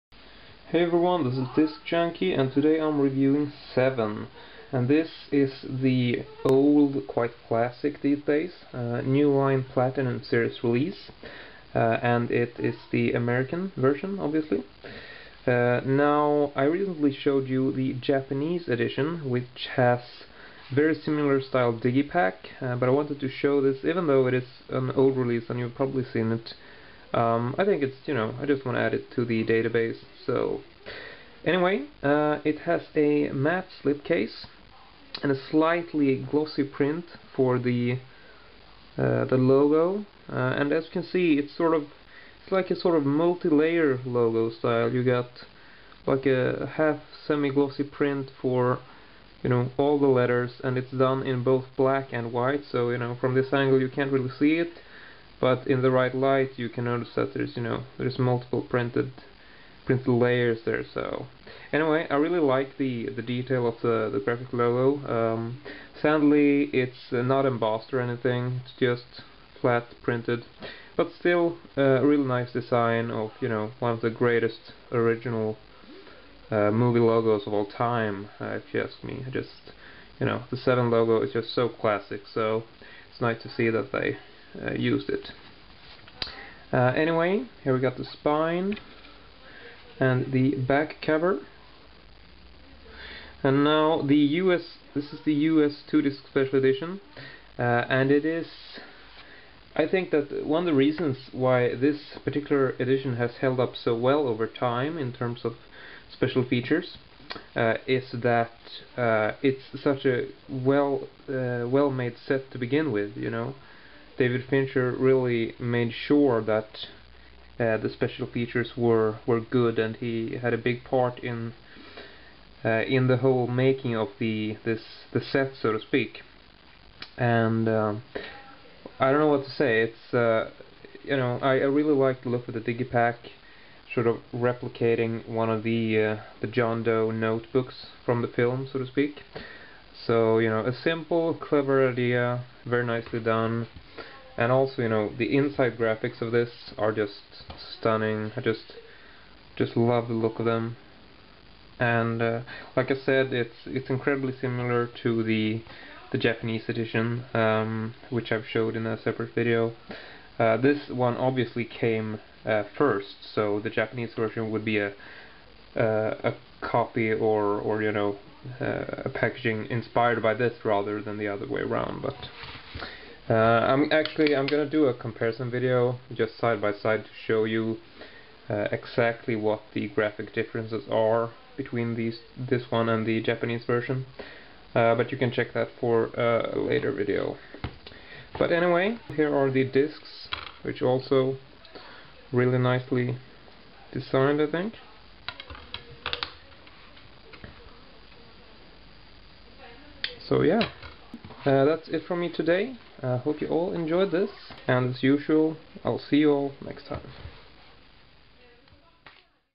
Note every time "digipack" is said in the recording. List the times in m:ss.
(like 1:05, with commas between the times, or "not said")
0:21, 2:12.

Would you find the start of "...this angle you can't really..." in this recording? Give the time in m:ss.
0:53.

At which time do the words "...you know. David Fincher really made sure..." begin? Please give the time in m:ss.
1:53.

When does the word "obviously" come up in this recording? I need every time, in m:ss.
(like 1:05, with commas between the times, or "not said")
0:14, 2:41.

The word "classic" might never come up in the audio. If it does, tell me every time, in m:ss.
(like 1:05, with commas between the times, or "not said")
0:07, 1:21.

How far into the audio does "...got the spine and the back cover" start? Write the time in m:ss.
1:27.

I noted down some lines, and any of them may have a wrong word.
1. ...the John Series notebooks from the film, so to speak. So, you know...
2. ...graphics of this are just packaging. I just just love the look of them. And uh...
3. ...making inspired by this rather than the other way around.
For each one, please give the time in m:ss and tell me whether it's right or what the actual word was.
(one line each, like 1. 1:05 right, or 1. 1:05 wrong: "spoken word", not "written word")
1. 2:16 wrong: "Doe", not "Series"
2. 2:25 wrong: "stunning", not "packaging"
3. 2:49 wrong: "packaging", not "making".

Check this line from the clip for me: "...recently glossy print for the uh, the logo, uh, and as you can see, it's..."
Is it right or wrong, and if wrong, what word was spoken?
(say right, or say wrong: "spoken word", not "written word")
wrong: "slightly", not "recently".